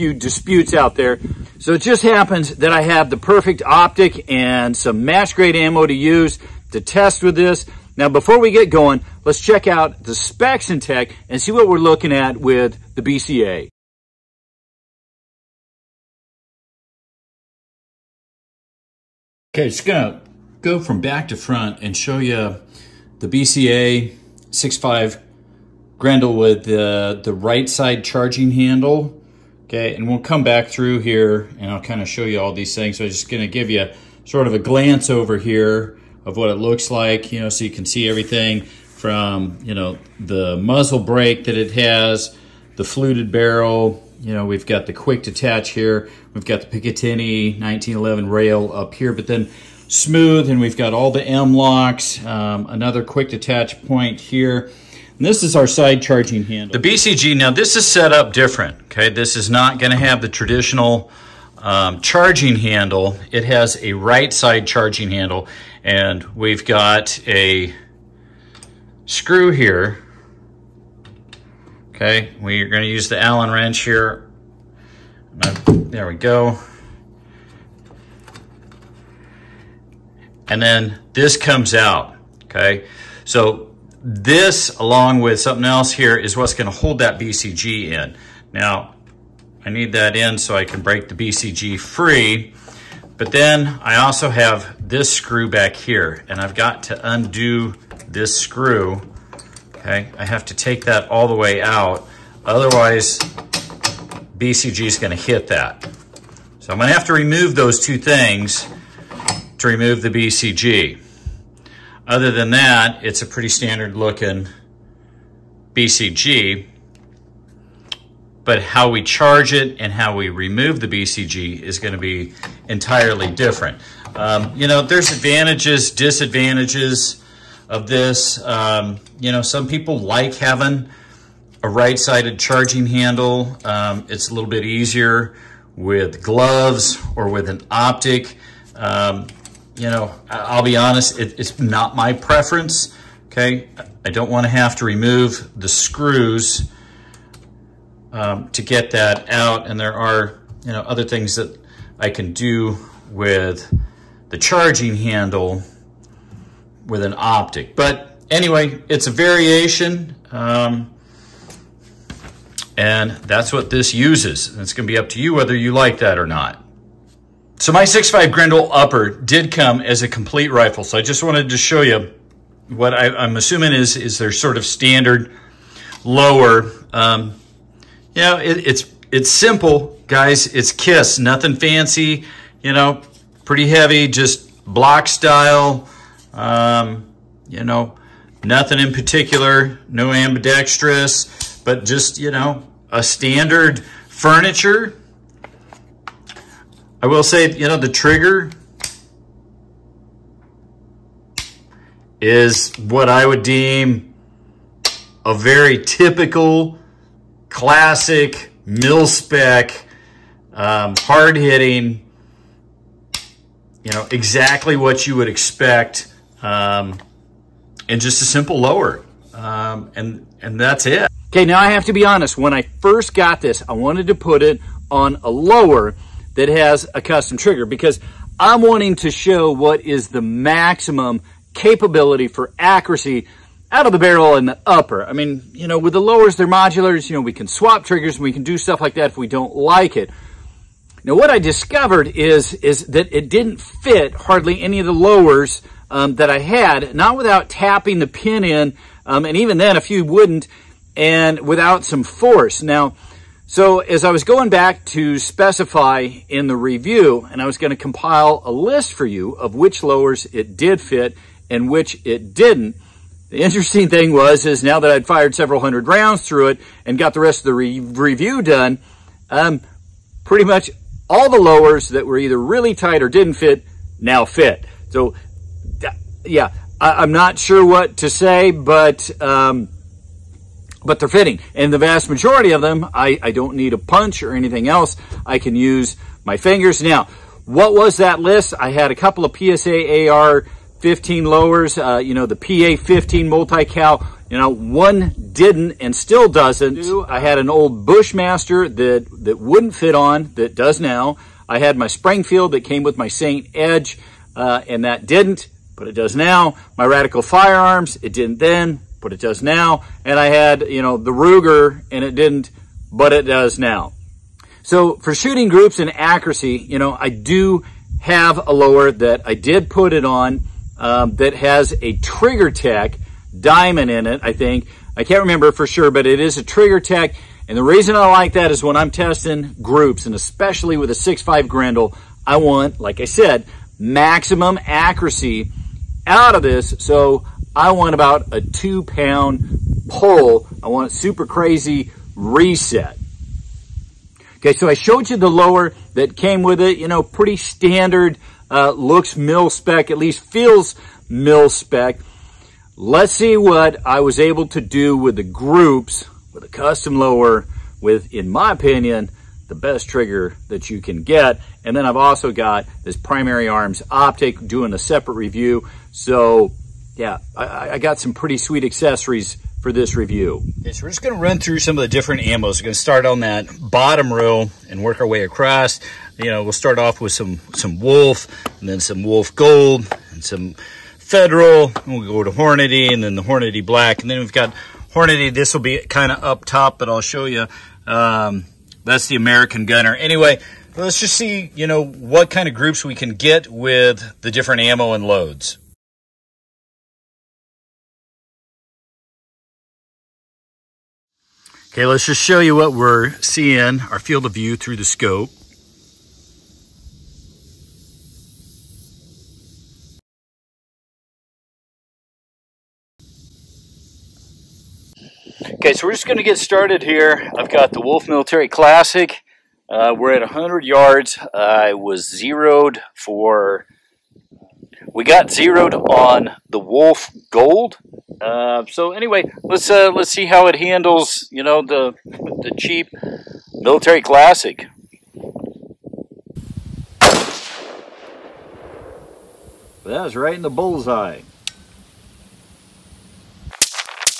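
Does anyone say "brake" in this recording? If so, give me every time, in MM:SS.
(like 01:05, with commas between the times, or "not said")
00:40.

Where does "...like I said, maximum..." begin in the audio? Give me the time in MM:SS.
05:32.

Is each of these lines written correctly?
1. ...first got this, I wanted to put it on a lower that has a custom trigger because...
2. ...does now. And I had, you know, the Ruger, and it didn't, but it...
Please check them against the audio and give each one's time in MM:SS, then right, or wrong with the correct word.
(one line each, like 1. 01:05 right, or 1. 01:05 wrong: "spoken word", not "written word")
1. 03:42 right
2. 05:09 right.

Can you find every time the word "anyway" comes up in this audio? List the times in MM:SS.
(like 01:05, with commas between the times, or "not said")
02:38, 06:29, 07:08.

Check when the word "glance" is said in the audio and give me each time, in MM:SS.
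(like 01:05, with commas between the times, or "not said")
00:34.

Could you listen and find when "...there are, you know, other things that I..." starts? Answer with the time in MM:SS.
02:29.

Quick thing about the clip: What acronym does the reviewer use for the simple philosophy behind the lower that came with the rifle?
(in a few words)
KISS.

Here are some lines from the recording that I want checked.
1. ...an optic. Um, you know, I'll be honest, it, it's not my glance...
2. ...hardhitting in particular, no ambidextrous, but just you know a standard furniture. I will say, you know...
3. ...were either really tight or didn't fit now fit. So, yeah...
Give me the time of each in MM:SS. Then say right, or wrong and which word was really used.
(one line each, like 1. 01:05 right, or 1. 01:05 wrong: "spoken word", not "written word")
1. 02:17 wrong: "preference", not "glance"
2. 03:08 wrong: "nothing", not "hardhitting"
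3. 04:32 right.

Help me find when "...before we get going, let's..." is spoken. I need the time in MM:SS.
00:08.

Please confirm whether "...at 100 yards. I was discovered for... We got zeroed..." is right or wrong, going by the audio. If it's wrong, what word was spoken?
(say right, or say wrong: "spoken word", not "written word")
wrong: "zeroed", not "discovered".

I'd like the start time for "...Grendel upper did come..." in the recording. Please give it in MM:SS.
02:48.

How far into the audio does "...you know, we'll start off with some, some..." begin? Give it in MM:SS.
06:16.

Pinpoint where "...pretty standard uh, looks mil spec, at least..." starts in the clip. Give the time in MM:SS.
05:47.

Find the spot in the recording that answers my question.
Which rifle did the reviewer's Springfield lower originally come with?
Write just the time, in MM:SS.
05:03.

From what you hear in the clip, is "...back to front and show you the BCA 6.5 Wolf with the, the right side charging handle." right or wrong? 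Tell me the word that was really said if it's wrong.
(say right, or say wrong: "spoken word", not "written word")
wrong: "Grendel", not "Wolf".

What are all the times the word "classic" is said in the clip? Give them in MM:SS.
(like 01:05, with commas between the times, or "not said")
03:27, 06:58, 07:14.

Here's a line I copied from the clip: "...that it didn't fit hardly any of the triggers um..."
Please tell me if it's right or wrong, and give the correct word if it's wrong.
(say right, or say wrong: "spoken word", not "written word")
wrong: "lowers", not "triggers".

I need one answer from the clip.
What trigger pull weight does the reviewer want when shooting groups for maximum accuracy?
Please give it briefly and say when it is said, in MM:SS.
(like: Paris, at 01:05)
2 pounds, at 05:38.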